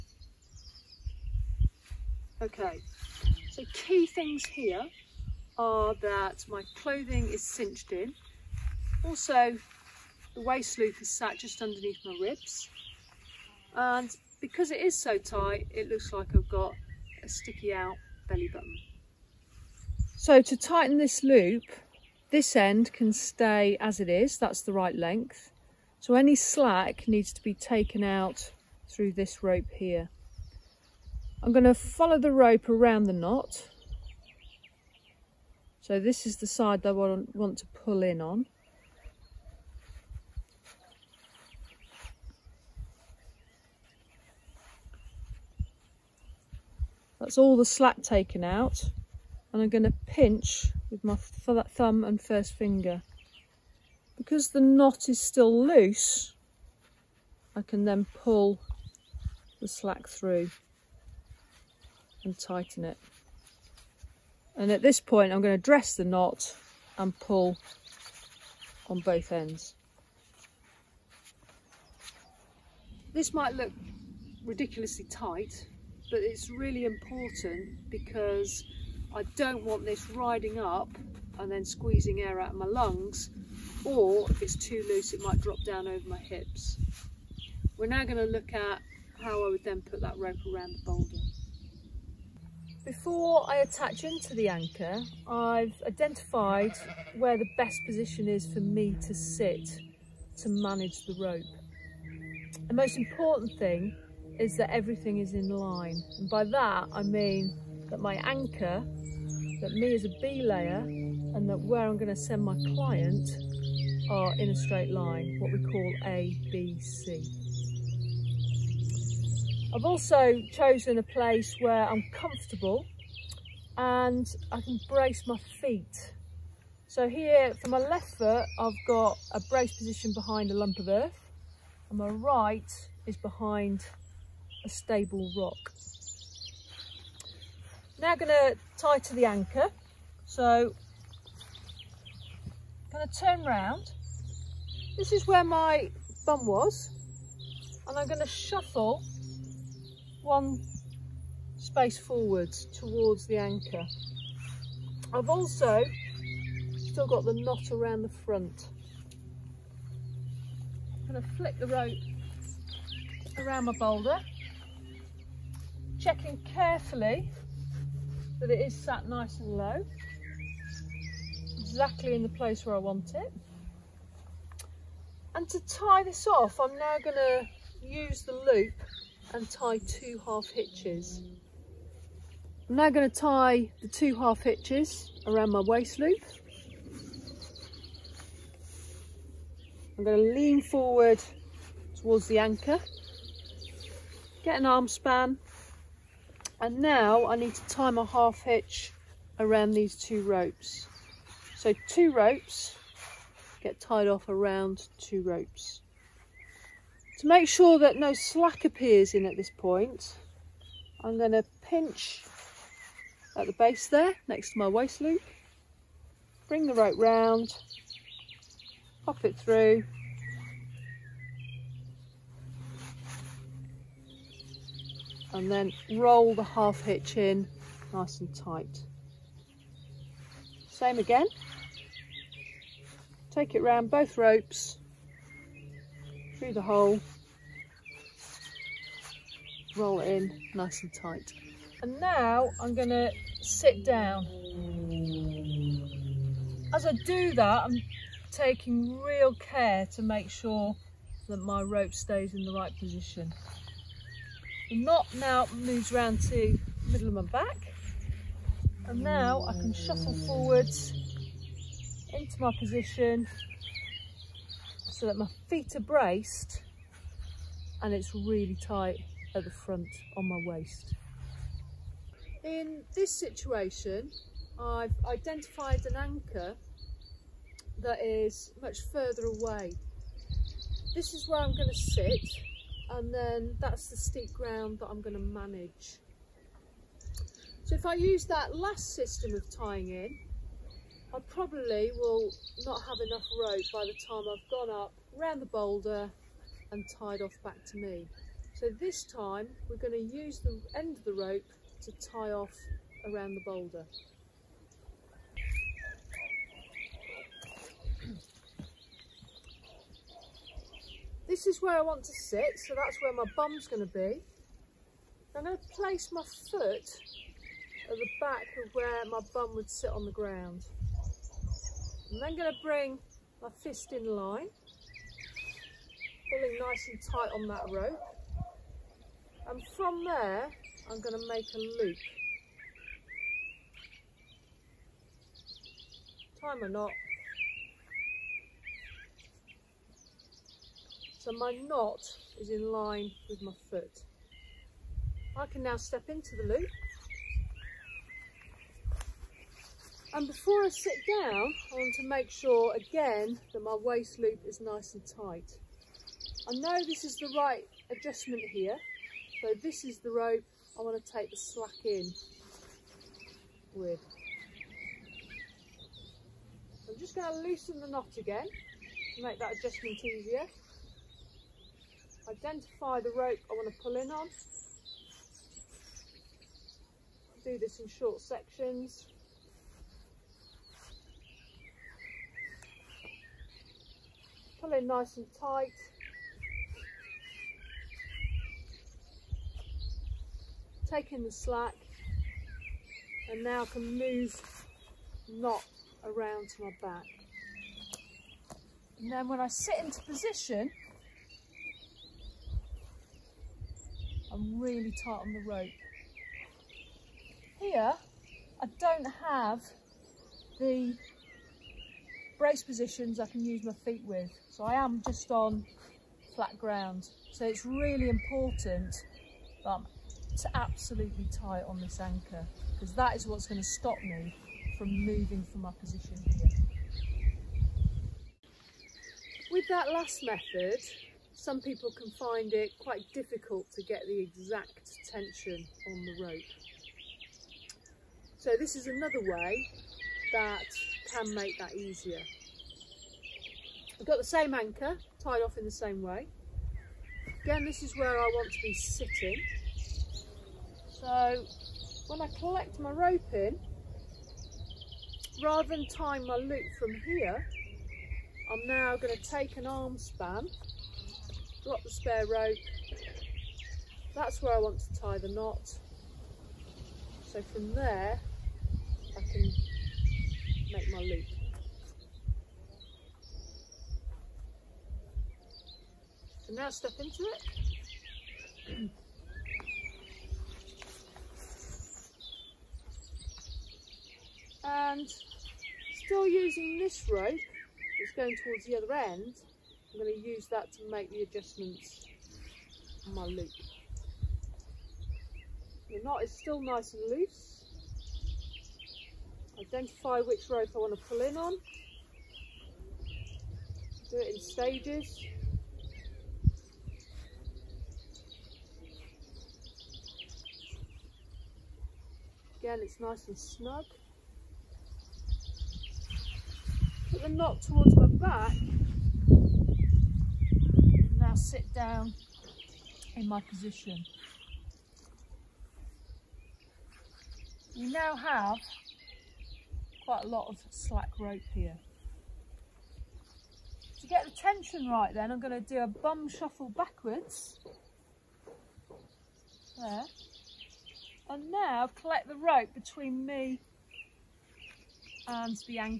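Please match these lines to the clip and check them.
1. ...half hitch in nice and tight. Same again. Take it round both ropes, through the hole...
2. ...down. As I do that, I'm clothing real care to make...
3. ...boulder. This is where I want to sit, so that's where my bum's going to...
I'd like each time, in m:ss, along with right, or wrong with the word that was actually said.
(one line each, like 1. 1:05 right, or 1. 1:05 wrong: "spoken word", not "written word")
1. 3:46 right
2. 4:03 wrong: "taking", not "clothing"
3. 5:03 right.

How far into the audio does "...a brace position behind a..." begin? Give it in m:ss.
2:09.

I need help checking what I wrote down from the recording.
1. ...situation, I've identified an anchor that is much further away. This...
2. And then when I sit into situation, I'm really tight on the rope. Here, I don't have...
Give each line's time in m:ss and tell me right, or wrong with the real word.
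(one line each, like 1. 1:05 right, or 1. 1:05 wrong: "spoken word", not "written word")
1. 4:33 right
2. 6:38 wrong: "position", not "situation".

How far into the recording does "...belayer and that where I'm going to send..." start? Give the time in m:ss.
1:50.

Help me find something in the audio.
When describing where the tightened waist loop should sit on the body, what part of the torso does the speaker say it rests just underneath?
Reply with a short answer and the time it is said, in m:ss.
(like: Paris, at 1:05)
ribs, at 0:12.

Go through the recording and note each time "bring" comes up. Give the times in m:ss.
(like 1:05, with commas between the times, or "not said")
3:36, 5:22.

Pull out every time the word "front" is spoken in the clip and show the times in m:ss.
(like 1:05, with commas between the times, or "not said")
2:38, 4:29.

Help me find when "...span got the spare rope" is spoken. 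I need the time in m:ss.
7:39.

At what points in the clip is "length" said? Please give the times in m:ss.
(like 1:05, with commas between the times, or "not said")
0:24.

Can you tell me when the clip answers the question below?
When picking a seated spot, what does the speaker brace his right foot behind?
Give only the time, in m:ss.
2:14.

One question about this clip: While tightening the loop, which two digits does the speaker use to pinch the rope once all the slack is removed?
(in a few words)
thumb and first finger.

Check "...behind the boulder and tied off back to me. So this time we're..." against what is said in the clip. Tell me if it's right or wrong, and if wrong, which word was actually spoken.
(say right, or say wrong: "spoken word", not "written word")
wrong: "round", not "behind".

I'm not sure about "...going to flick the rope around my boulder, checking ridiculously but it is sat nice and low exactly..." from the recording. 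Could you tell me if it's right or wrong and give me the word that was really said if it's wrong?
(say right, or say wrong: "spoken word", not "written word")
wrong: "carefully", not "ridiculously".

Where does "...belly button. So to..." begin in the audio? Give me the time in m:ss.
0:18.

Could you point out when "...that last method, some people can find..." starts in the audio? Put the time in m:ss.
7:09.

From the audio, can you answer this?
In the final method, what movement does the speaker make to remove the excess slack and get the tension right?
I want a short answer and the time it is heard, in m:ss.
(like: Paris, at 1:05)
a bum shuffle backwards, at 8:55.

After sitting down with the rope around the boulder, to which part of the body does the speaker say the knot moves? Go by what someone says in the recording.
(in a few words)
middle of my back.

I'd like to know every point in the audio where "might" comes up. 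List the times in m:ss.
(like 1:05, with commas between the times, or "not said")
1:13, 1:25.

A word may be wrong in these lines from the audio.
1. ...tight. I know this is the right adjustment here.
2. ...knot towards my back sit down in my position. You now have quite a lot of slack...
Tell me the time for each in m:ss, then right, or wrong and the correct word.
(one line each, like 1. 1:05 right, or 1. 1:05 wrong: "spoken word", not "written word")
1. 5:55 right
2. 8:37 right.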